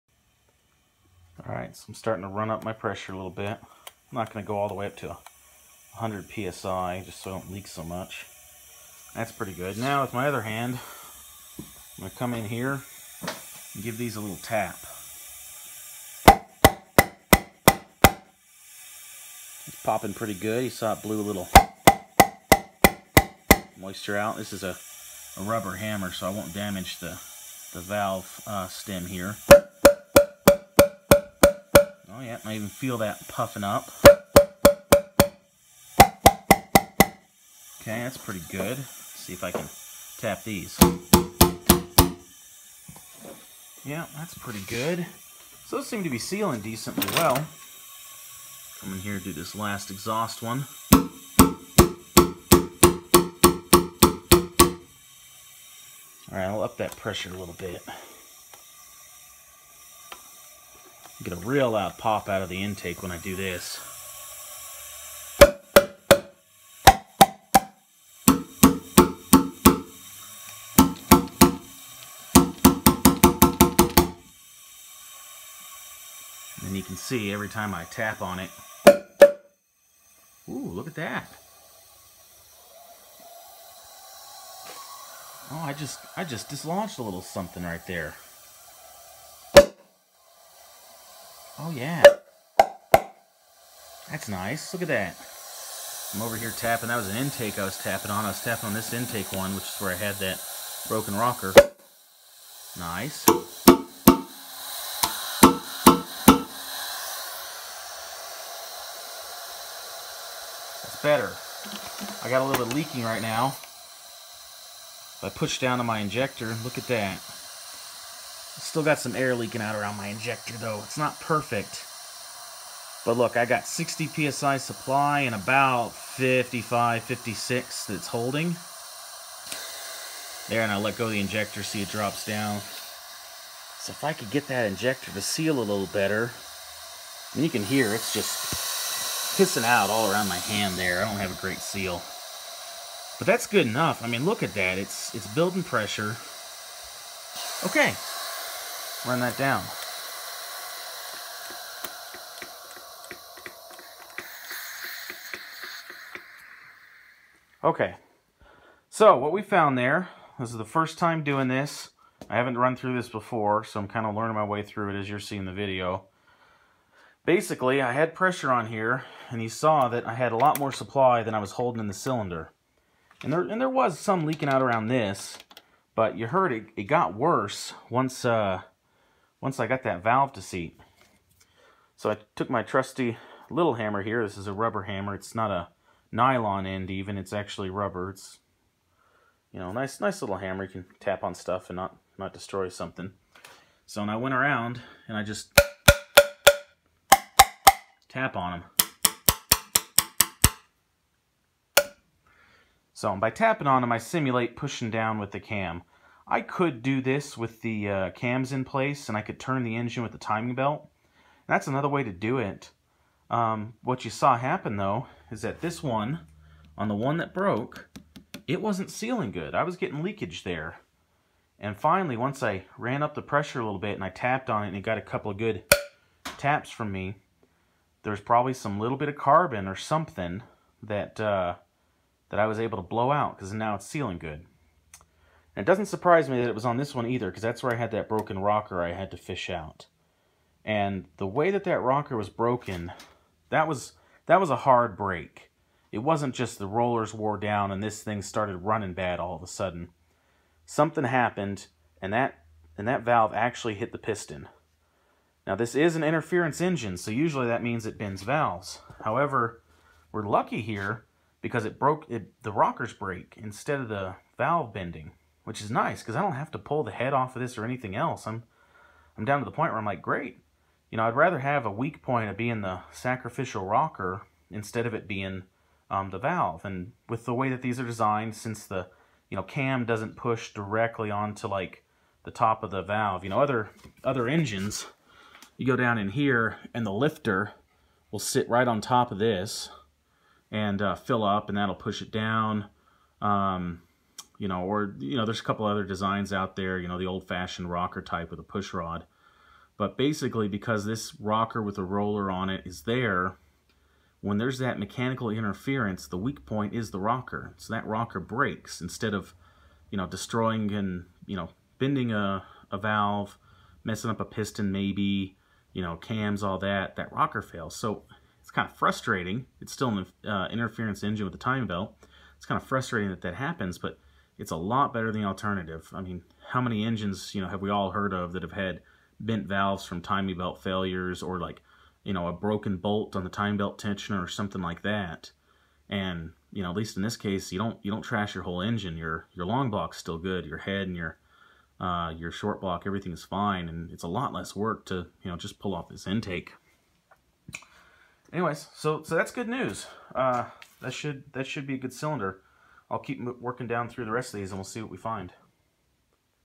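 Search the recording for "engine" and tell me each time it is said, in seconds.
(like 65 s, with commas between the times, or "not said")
209 s, 256 s, 284 s, 321 s, 326 s, 338 s.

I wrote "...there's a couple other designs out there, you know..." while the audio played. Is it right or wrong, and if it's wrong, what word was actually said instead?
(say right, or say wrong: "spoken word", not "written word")
right.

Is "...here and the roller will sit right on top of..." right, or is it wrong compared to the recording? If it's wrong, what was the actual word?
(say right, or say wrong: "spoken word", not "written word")
wrong: "lifter", not "roller".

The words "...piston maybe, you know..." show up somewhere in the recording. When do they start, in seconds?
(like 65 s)
314 s.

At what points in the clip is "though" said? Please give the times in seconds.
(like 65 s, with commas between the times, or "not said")
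120 s, 214 s.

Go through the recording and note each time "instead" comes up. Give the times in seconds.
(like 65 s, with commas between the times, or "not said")
263 s, 274 s, 308 s.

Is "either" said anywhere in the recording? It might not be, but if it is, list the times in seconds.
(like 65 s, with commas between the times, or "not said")
237 s.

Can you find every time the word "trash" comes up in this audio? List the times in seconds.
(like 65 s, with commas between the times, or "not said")
338 s.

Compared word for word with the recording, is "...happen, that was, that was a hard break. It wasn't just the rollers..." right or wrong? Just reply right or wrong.
wrong.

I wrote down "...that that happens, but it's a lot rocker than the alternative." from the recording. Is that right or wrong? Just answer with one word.
wrong.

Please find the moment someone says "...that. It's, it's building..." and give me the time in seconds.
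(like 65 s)
144 s.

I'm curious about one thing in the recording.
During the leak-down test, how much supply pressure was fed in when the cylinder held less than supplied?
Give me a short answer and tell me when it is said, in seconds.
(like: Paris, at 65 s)
60 PSI, at 123 s.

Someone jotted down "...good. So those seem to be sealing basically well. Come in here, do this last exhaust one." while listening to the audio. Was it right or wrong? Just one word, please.
wrong.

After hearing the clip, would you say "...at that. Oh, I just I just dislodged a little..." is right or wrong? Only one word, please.
right.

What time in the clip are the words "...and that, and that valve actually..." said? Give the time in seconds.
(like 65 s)
252 s.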